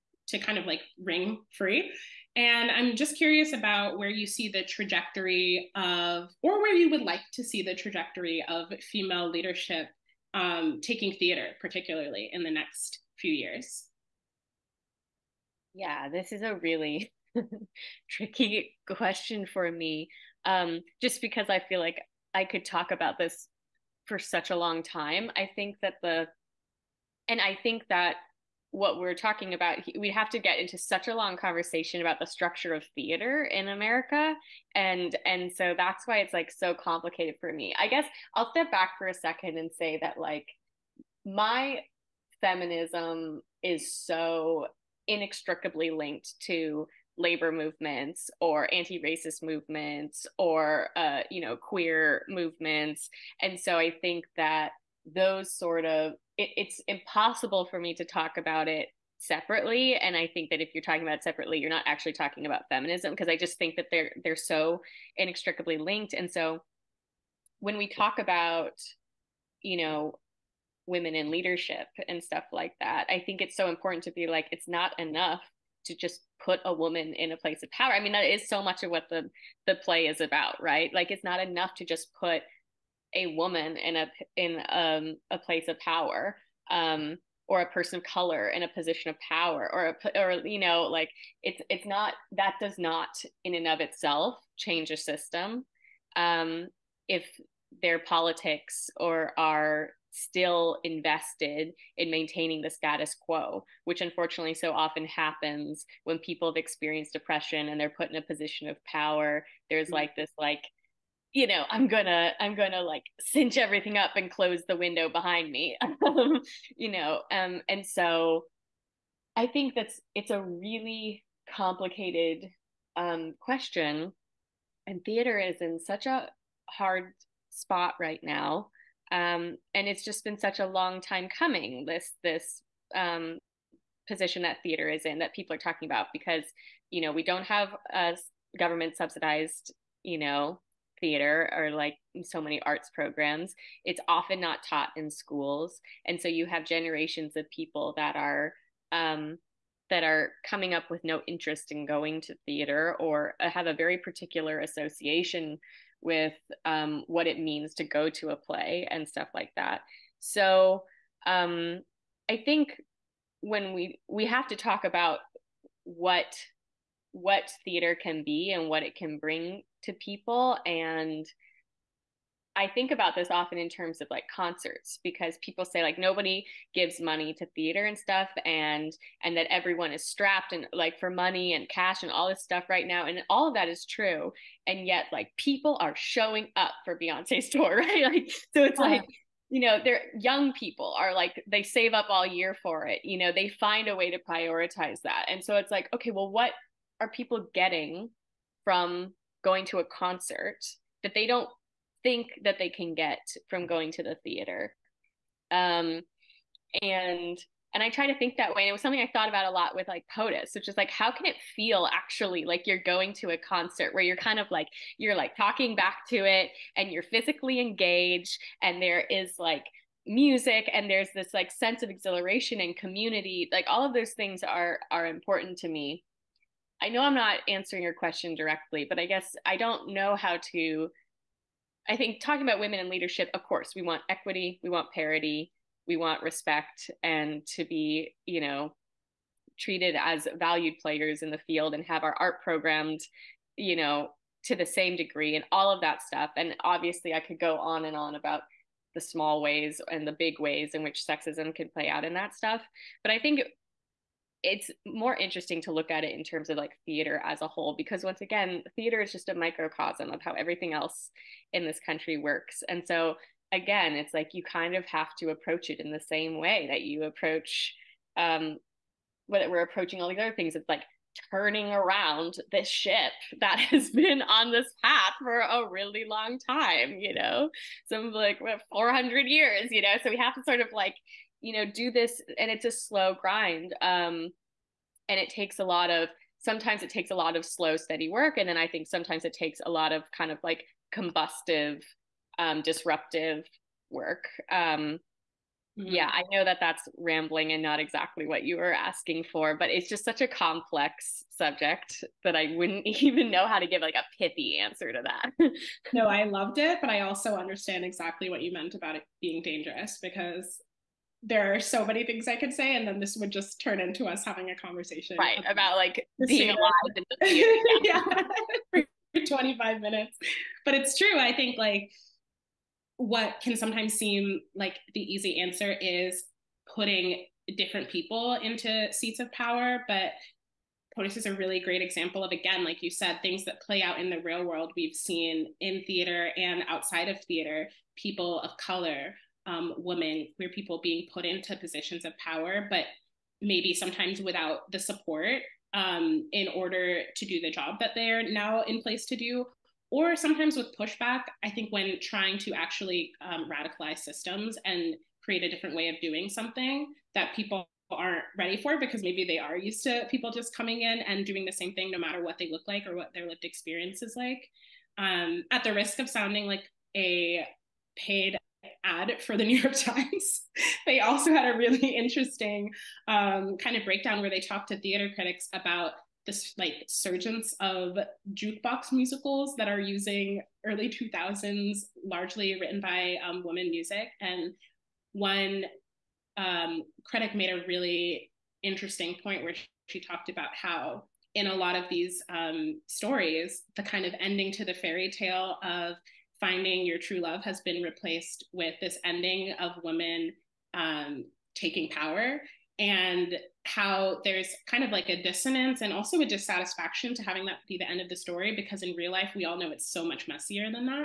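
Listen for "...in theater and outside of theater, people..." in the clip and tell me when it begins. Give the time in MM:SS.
05:35.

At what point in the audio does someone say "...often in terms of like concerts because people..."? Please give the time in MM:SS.
02:53.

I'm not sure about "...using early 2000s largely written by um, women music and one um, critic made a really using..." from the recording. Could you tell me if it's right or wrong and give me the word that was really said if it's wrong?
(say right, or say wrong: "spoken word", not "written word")
wrong: "interesting", not "using".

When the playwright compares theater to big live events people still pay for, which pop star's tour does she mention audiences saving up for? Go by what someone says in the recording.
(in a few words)
Beyonce.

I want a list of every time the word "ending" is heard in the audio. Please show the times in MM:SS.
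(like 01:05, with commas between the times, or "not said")
06:34, 06:39.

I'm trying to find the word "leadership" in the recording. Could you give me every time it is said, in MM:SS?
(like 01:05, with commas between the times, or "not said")
00:09, 01:11, 03:52.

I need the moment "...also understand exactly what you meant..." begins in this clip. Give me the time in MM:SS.
05:07.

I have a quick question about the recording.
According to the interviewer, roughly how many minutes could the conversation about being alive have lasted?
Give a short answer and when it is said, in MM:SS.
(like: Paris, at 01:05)
25 minutes, at 05:19.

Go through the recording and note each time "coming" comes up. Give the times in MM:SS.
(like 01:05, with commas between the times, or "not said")
02:11, 02:30, 06:00.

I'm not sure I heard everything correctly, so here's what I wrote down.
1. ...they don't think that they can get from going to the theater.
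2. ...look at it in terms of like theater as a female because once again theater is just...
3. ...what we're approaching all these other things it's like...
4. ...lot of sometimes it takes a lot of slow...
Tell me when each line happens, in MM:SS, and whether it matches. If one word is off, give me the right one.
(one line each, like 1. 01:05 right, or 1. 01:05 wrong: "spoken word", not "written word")
1. 03:21 right
2. 04:15 wrong: "whole", not "female"
3. 04:29 right
4. 04:45 right.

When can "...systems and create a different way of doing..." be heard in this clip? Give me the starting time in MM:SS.
05:53.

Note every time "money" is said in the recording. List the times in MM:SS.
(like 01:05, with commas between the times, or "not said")
02:57, 03:01.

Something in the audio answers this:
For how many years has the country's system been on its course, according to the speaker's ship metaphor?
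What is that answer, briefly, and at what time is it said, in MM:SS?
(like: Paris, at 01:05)
400, at 04:38.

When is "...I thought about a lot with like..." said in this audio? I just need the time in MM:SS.
03:29.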